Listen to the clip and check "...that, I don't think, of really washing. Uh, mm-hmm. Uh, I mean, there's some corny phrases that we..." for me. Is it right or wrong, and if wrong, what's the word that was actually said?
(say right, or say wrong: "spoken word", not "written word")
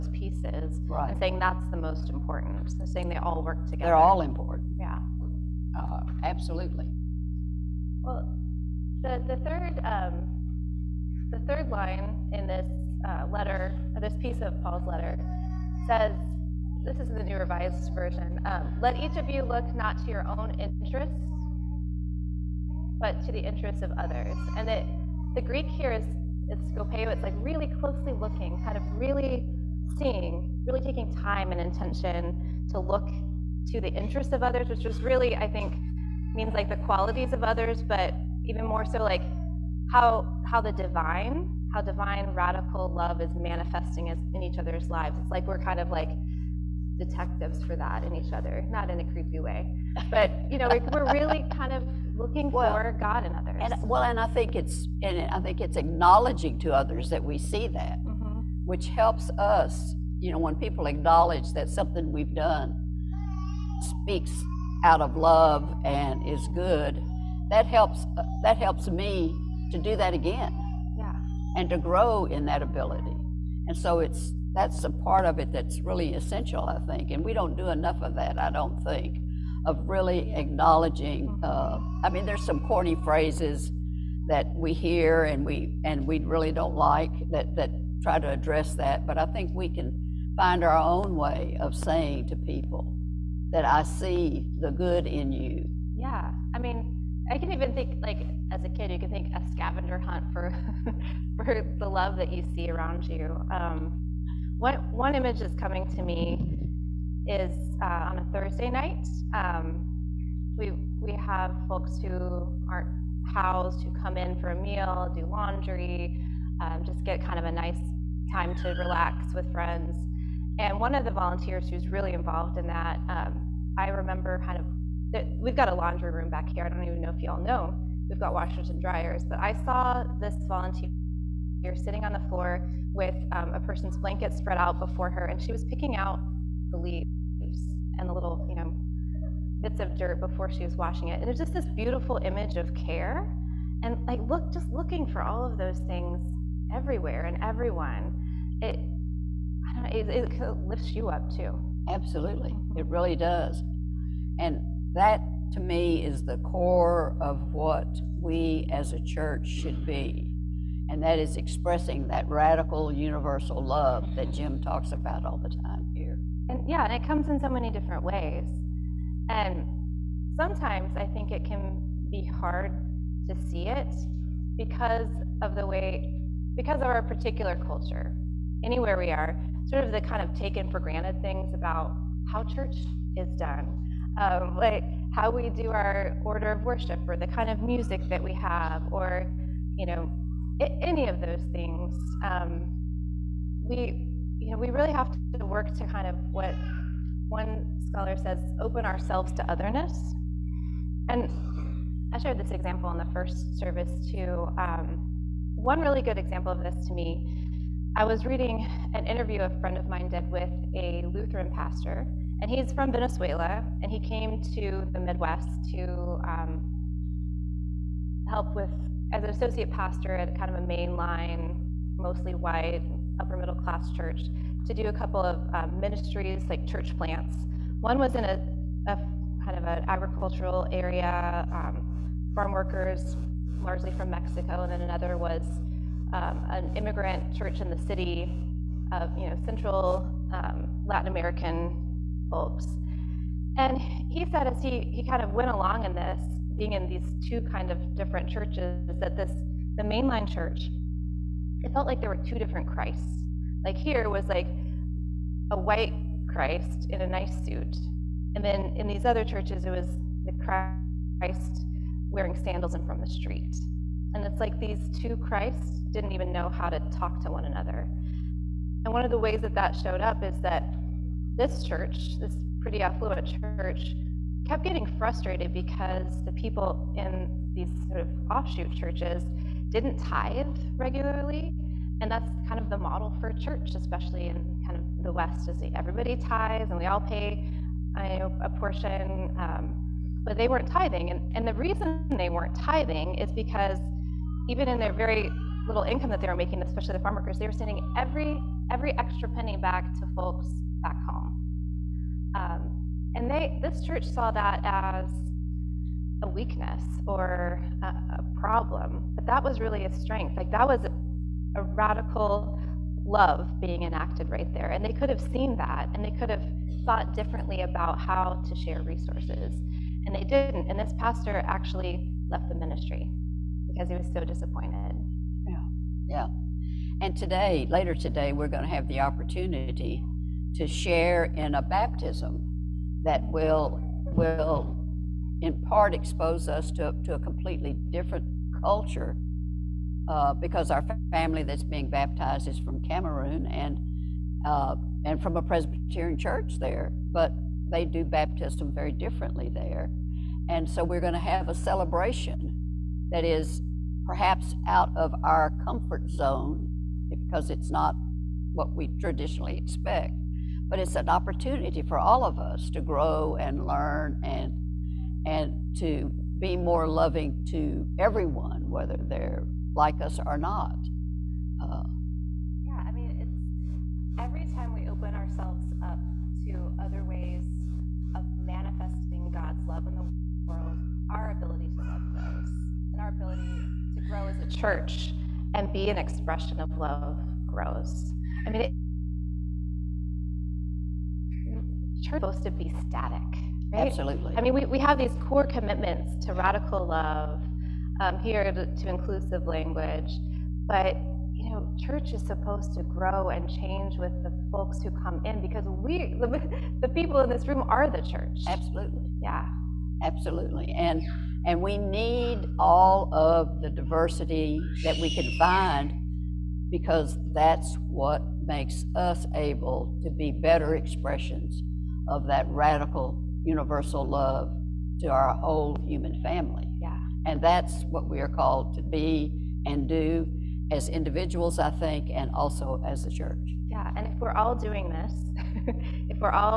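wrong: "acknowledging", not "washing".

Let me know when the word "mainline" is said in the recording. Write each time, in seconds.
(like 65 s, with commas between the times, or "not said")
220 s, 249 s.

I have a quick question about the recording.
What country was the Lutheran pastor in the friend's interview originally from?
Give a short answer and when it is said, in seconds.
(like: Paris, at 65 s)
Venezuela, at 212 s.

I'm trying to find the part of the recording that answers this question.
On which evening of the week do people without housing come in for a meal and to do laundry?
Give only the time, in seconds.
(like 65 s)
108 s.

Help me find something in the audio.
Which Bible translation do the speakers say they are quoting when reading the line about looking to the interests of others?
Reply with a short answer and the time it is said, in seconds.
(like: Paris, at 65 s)
New Revised Version, at 17 s.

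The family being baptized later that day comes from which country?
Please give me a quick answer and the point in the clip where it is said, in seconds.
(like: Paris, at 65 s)
Cameroon, at 342 s.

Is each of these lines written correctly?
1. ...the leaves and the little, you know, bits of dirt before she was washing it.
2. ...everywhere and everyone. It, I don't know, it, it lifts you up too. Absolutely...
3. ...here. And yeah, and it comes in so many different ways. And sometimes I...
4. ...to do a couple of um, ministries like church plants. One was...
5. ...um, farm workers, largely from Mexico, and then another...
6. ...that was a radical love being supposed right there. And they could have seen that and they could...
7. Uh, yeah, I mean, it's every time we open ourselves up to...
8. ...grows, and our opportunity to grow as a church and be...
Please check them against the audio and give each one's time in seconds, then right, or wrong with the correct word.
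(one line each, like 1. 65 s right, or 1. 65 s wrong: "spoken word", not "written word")
1. 136 s right
2. 146 s right
3. 165 s right
4. 224 s right
5. 231 s right
6. 310 s wrong: "enacted", not "supposed"
7. 371 s right
8. 382 s wrong: "ability", not "opportunity".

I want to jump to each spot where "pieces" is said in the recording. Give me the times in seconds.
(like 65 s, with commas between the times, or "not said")
0 s, 14 s.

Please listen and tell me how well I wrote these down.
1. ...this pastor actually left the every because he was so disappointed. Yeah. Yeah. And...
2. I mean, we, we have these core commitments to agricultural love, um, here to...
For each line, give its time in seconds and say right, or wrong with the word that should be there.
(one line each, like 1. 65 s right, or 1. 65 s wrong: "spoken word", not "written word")
1. 320 s wrong: "ministry", not "every"
2. 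394 s wrong: "radical", not "agricultural".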